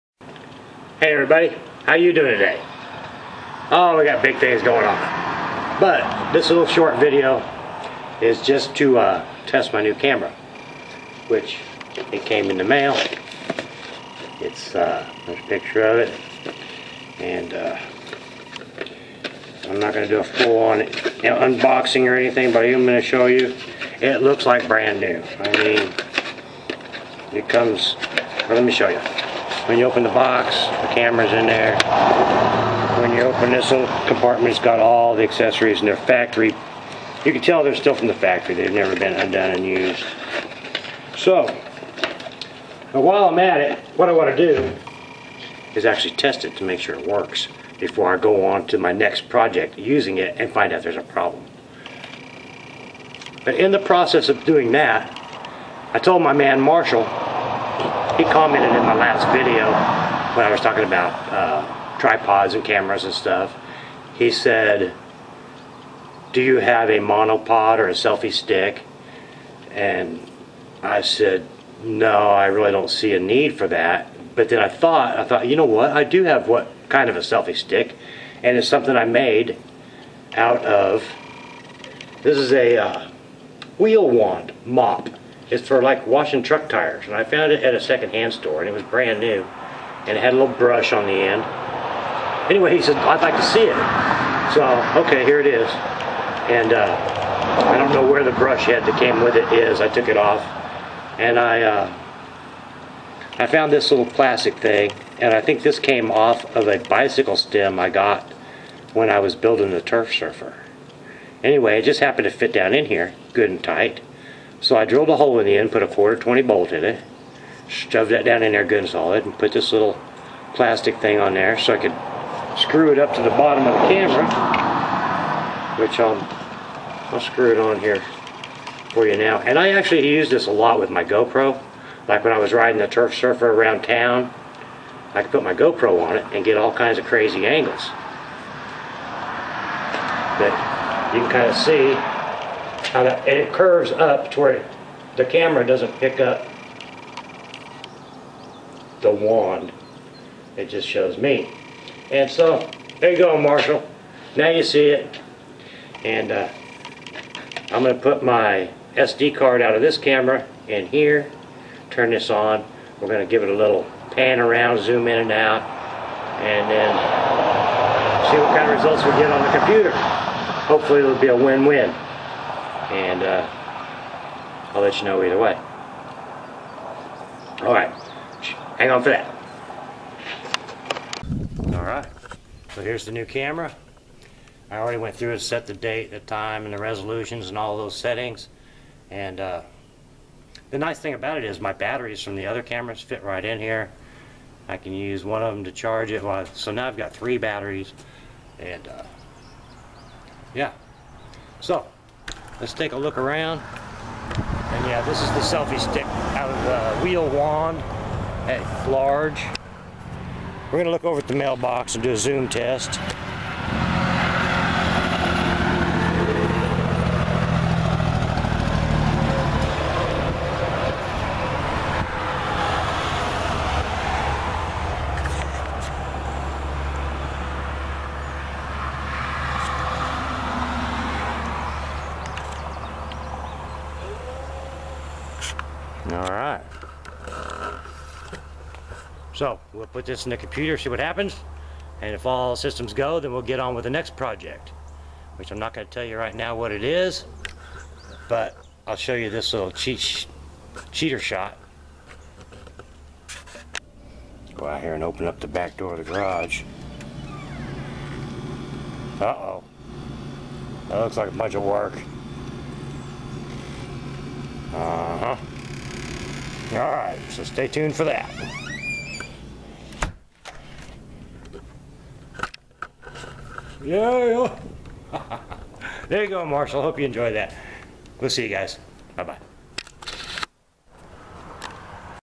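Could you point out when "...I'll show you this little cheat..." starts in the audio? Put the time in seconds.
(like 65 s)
248 s.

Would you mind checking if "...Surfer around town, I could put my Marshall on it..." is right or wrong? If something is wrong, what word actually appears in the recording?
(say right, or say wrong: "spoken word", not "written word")
wrong: "GoPro", not "Marshall".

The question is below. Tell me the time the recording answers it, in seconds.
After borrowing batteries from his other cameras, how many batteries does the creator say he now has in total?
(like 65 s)
197 s.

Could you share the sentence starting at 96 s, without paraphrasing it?
And uh, I don't know where the brush head that came with it is.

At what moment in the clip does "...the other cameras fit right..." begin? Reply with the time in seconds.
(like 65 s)
192 s.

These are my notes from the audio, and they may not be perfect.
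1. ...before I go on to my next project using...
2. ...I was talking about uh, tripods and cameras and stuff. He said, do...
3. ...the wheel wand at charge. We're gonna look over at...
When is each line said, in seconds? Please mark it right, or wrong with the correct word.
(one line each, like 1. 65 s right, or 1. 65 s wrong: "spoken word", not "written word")
1. 47 s right
2. 60 s right
3. 207 s wrong: "large", not "charge".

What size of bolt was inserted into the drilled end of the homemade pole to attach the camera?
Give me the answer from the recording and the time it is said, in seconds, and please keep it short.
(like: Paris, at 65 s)
Quarter 20, at 115 s.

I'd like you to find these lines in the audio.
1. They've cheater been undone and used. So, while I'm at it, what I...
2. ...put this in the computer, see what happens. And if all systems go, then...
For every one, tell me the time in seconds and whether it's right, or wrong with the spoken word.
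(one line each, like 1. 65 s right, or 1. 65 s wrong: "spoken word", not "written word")
1. 38 s wrong: "never", not "cheater"
2. 239 s right.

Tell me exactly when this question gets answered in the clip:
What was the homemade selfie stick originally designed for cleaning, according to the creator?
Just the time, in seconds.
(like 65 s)
86 s.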